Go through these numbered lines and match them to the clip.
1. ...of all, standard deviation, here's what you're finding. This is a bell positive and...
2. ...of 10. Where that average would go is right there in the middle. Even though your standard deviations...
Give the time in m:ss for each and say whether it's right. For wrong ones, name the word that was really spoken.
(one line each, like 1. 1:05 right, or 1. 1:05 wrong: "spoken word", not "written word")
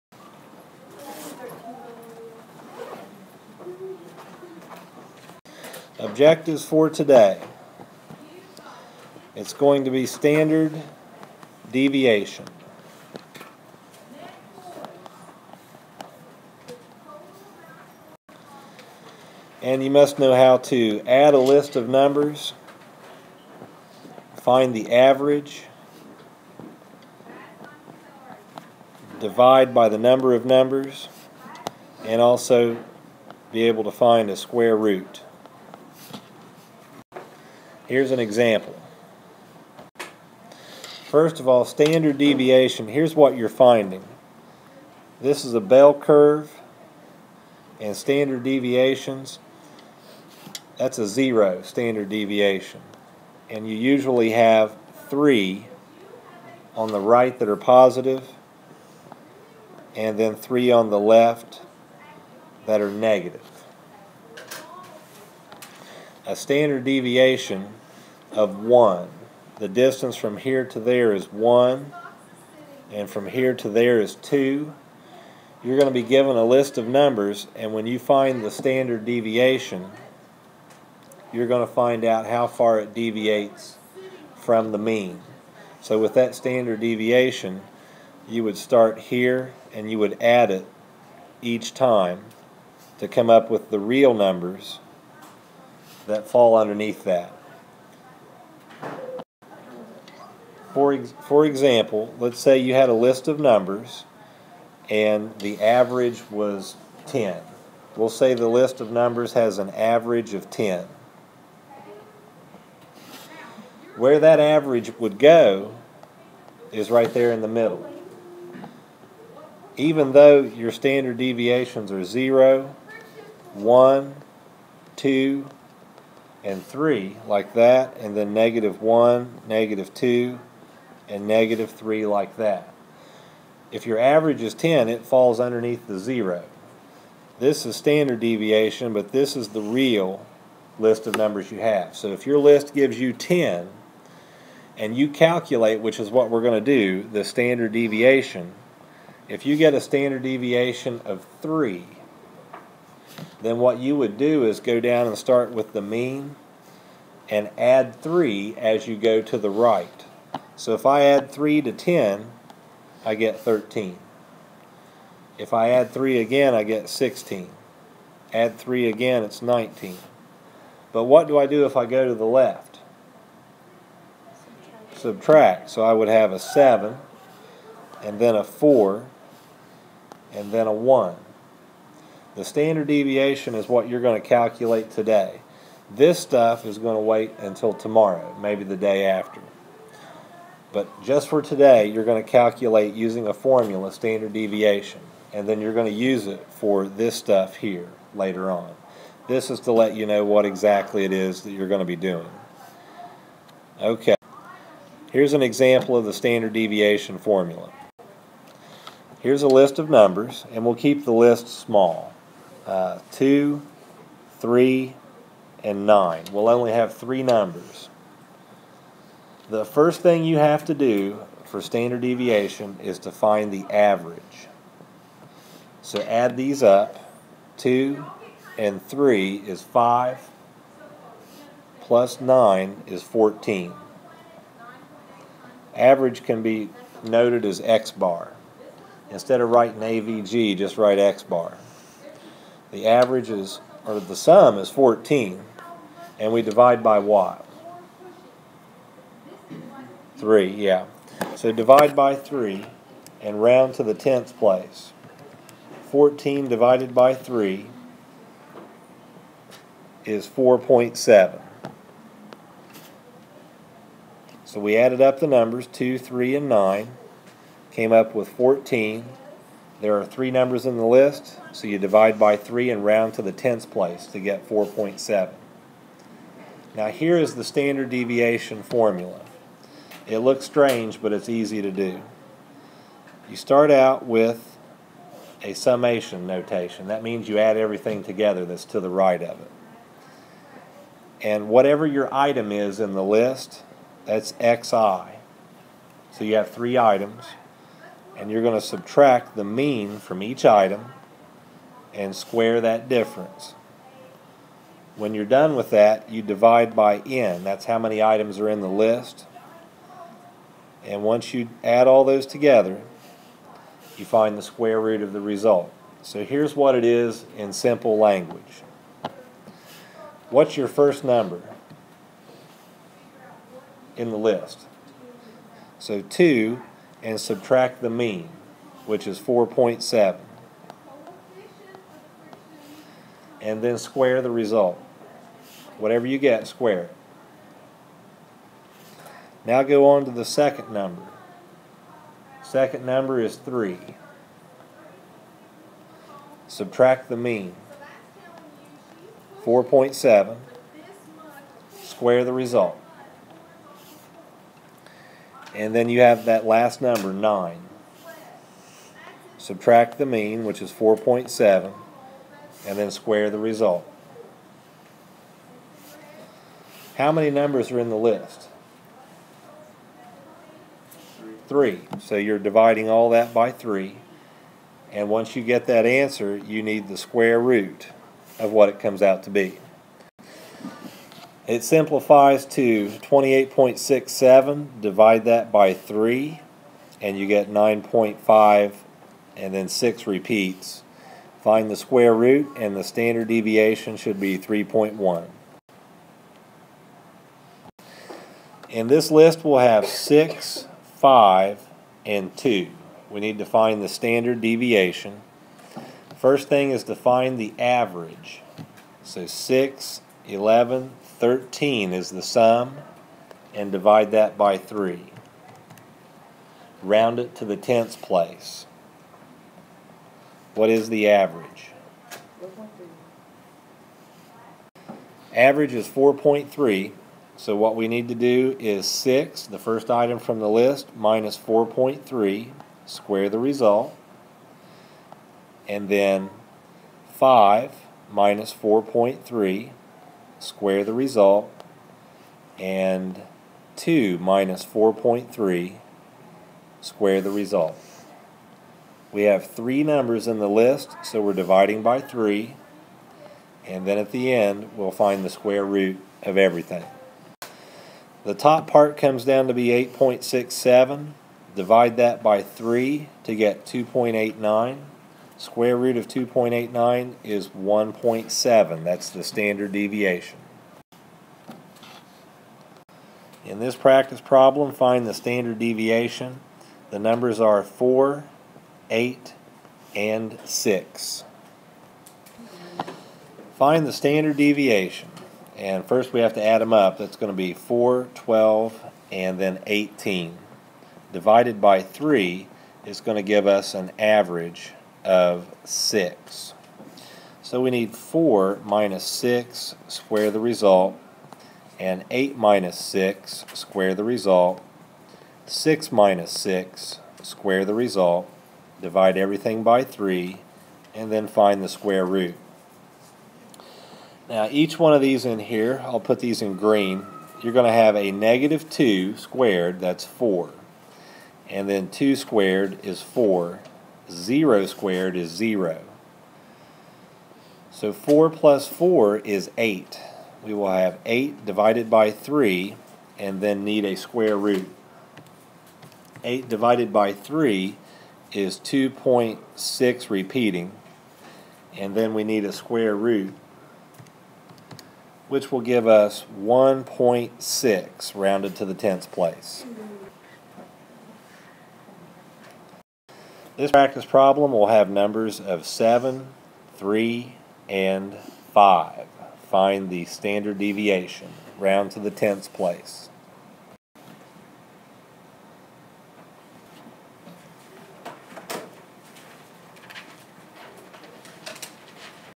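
1. 0:41 wrong: "curve", not "positive"
2. 1:50 right.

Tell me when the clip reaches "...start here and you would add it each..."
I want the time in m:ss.
1:28.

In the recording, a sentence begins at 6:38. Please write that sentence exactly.
In this list, we'll have six 5, and 2.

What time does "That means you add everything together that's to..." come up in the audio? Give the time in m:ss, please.
4:46.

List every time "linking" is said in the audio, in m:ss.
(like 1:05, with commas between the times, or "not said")
not said.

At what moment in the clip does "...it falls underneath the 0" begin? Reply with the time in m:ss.
2:14.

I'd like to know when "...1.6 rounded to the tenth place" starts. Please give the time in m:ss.
9:06.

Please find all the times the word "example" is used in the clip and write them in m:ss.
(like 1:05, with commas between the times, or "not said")
0:38, 1:41, 3:25.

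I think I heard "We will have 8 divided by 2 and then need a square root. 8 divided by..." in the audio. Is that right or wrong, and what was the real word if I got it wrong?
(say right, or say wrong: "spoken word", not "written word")
wrong: "3", not "2".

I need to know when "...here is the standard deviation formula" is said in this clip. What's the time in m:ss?
4:36.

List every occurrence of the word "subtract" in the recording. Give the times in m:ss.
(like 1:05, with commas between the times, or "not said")
2:54, 4:58, 5:27, 5:46, 5:59.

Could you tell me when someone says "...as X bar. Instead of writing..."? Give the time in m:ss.
3:57.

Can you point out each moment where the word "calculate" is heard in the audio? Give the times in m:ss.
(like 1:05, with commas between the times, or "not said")
2:25, 3:04, 3:12.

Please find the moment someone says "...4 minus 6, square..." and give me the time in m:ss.
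8:17.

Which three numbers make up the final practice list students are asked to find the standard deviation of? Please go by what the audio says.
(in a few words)
7, 3, and 5.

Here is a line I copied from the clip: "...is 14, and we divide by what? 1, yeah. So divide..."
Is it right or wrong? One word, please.
wrong.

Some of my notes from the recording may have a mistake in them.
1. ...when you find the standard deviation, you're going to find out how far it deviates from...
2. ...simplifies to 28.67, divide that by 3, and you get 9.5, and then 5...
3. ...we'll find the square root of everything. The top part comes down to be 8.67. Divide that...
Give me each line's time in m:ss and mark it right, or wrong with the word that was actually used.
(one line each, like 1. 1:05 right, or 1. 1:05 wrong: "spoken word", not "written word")
1. 1:17 right
2. 6:21 wrong: "6", not "5"
3. 7:34 right.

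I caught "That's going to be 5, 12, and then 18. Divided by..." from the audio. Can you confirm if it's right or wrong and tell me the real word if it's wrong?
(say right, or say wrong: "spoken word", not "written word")
wrong: "4", not "5".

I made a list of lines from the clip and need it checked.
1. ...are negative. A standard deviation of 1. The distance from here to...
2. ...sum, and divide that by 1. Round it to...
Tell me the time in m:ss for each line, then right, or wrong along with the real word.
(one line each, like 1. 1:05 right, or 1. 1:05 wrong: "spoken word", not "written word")
1. 1:02 right
2. 6:52 wrong: "3", not "1".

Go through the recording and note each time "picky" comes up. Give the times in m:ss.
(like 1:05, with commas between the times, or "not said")
not said.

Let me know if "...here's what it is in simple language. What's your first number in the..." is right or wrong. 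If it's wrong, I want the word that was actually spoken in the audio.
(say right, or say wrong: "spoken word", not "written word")
right.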